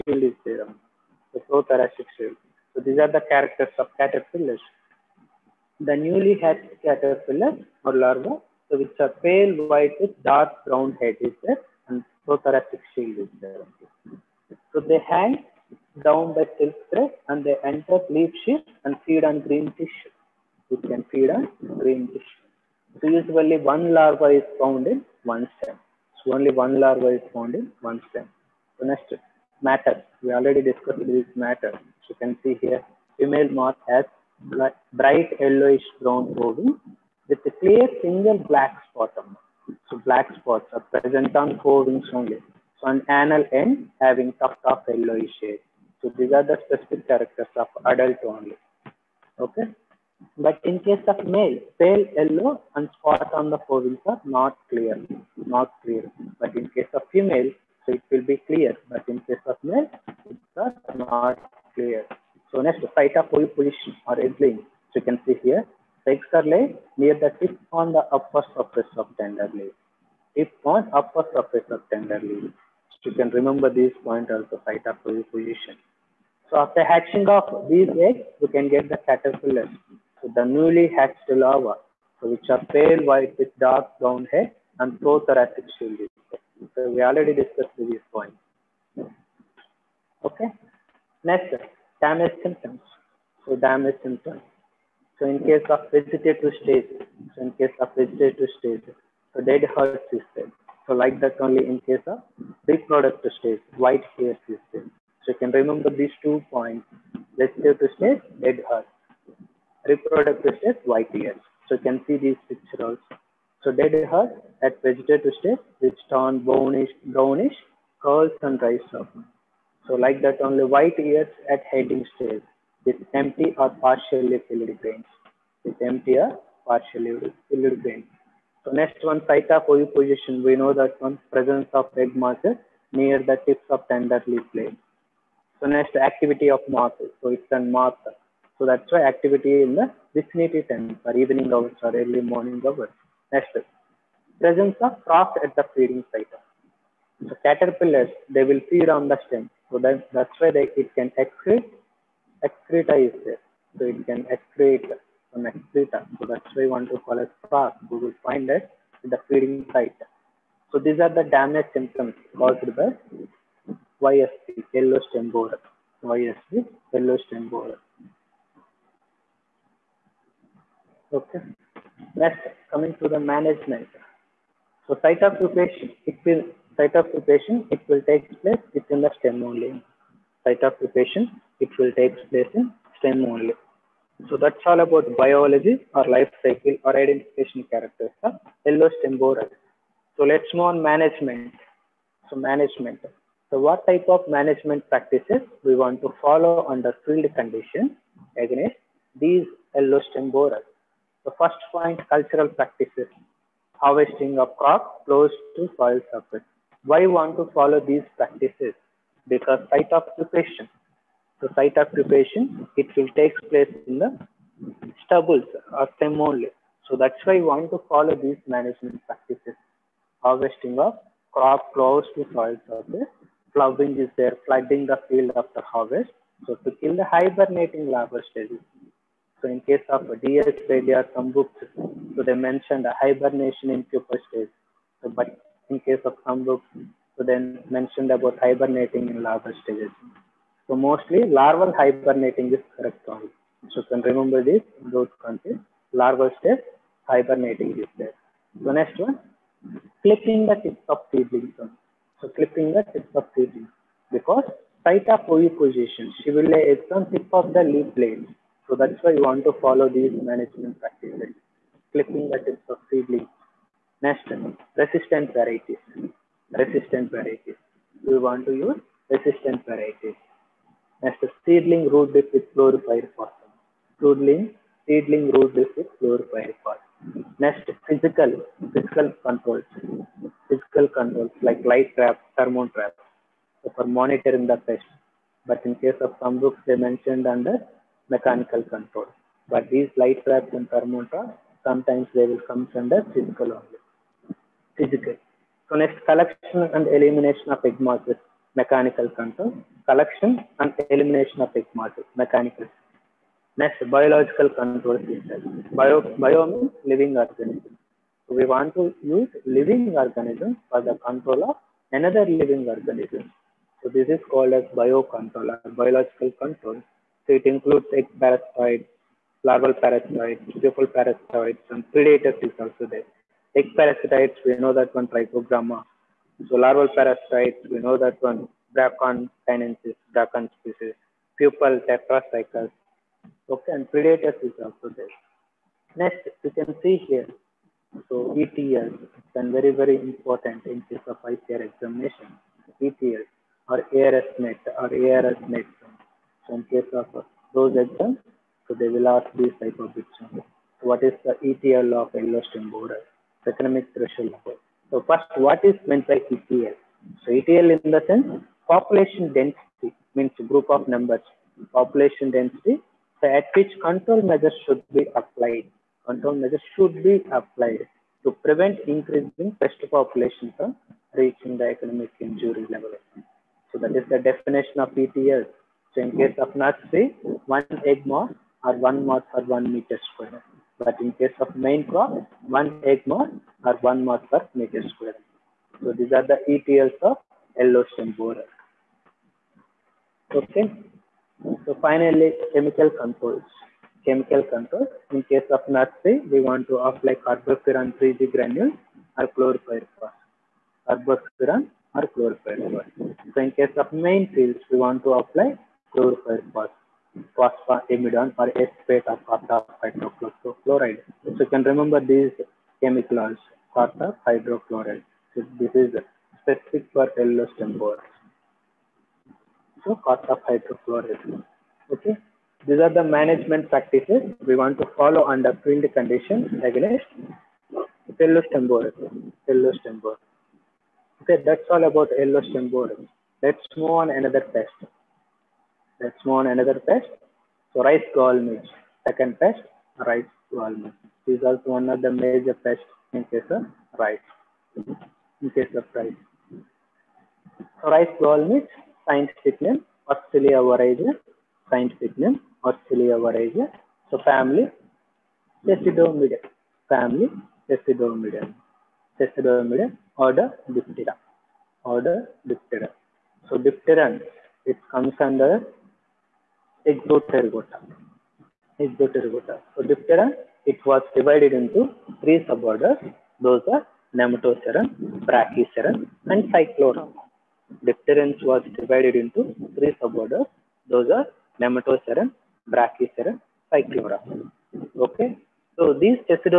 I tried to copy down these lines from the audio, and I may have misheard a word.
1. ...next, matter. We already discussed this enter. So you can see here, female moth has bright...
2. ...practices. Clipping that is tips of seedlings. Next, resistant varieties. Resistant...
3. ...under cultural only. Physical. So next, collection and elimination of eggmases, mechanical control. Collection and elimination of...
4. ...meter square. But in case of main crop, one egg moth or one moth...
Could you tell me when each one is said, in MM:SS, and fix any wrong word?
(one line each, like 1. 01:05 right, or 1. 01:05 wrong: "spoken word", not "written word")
1. 00:28 wrong: "matter", not "enter"
2. 04:20 right
3. 04:52 wrong: "physical", not "cultural"
4. 06:19 right.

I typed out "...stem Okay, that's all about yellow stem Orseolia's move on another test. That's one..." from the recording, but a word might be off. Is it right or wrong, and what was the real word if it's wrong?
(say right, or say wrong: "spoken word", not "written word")
wrong: "Let", not "Orseolia".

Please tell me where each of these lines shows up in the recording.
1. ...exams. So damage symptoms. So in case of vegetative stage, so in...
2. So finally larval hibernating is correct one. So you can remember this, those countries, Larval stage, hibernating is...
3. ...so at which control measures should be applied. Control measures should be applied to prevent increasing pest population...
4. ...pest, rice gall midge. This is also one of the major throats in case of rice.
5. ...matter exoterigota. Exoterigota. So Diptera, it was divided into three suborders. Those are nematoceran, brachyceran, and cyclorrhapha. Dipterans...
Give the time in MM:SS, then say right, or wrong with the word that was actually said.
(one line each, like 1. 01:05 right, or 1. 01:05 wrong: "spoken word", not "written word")
1. 01:32 wrong: "symptoms", not "exams"
2. 04:00 wrong: "mostly", not "finally"
3. 06:03 right
4. 07:19 wrong: "pests", not "throats"
5. 07:45 wrong: "under", not "matter".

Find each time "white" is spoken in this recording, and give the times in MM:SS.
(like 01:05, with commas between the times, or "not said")
00:09, 01:23, 01:43, 02:00.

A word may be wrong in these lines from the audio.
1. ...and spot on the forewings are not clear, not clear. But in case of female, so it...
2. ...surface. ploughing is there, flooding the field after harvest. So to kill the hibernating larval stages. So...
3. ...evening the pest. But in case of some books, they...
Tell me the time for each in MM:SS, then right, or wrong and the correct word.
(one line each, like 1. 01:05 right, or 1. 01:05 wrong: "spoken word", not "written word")
1. 00:52 right
2. 03:42 right
3. 04:43 wrong: "monitoring", not "evening".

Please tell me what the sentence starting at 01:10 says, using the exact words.
Tip on upper surface of tender leaf.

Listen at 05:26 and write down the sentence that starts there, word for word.
So larval parasitoids, we know that one, Bracon sinensis, Bracon species, pupal tetracycles.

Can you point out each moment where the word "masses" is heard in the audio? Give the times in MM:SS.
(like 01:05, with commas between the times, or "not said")
02:12, 02:16.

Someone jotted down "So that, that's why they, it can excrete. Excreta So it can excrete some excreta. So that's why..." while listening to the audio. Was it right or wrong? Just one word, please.
right.